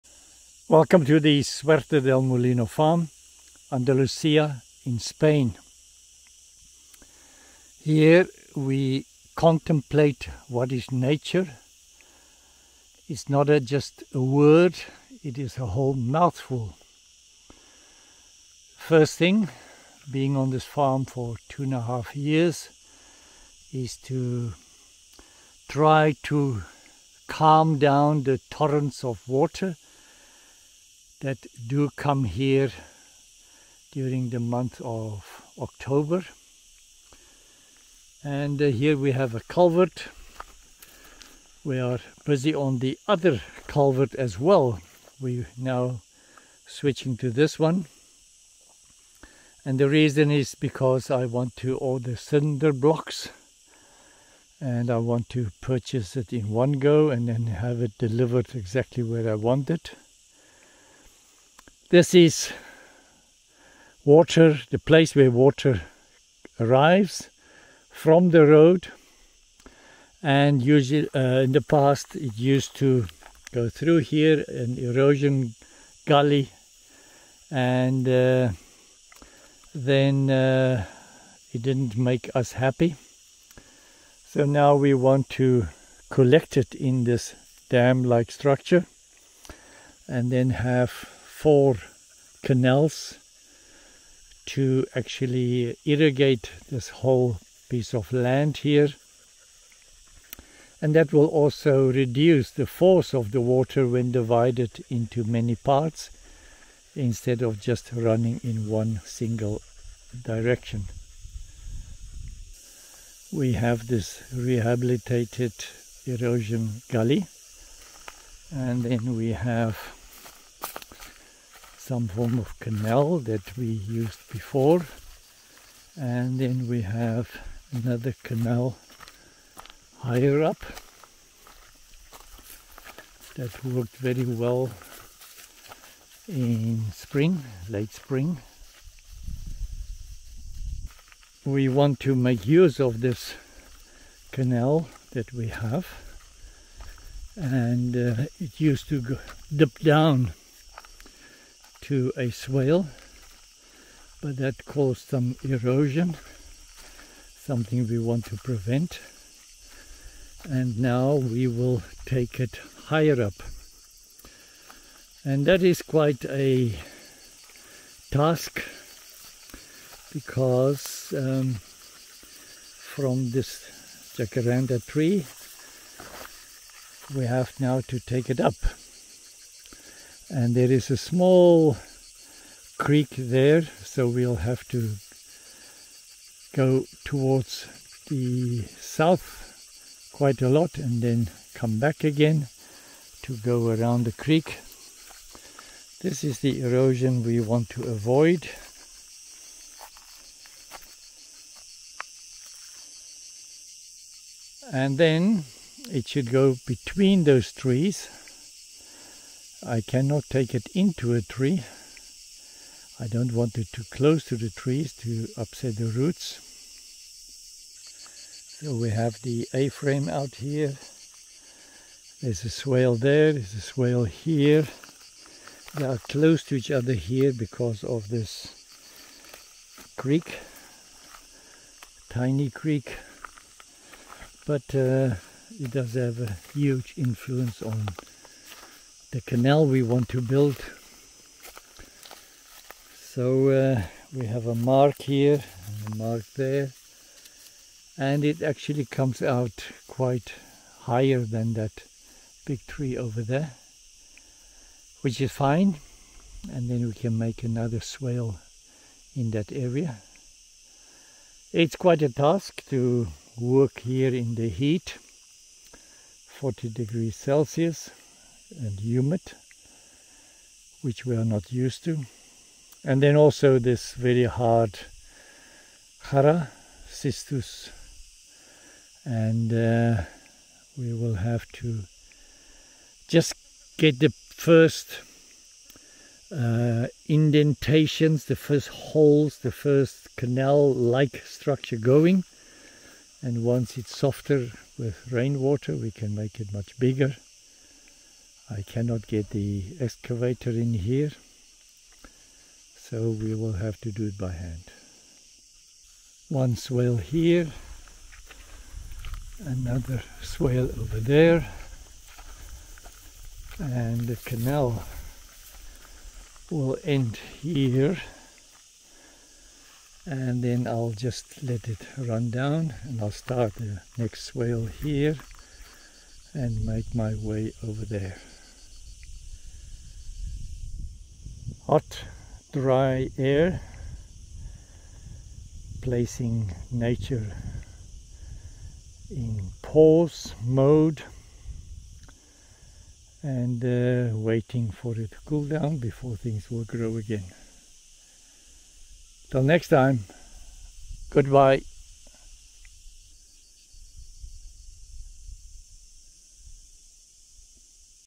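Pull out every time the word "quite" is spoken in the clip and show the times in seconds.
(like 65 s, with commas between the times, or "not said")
165 s, 190 s, 249 s, 261 s.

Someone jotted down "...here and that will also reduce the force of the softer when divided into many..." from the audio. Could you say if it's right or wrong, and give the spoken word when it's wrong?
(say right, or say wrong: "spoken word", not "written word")
wrong: "water", not "softer".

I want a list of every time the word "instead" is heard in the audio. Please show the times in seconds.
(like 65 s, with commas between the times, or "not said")
106 s.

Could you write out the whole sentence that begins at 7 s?
Here we contemplate what is nature.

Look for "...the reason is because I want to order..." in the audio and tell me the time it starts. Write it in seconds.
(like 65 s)
49 s.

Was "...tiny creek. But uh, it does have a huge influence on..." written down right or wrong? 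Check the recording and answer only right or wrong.
right.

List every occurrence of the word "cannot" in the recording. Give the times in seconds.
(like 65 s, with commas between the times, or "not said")
209 s, 298 s.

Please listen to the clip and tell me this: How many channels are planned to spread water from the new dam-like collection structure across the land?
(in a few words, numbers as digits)
4.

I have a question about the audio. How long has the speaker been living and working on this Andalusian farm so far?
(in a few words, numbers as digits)
2.5 years.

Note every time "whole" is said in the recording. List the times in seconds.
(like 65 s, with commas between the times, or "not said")
15 s, 96 s.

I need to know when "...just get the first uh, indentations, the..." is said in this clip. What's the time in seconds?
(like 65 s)
283 s.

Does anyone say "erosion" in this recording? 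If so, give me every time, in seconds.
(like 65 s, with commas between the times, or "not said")
74 s, 116 s, 155 s, 196 s.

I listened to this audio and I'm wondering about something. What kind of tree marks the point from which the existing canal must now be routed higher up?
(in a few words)
Jacaranda.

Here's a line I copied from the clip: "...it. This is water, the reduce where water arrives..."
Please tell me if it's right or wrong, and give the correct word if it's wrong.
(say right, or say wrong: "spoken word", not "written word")
wrong: "place", not "reduce".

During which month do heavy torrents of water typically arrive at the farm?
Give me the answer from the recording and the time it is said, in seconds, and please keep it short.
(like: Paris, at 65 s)
October, at 35 s.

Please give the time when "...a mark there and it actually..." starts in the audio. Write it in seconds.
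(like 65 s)
245 s.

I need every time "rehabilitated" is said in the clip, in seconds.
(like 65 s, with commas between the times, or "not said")
114 s.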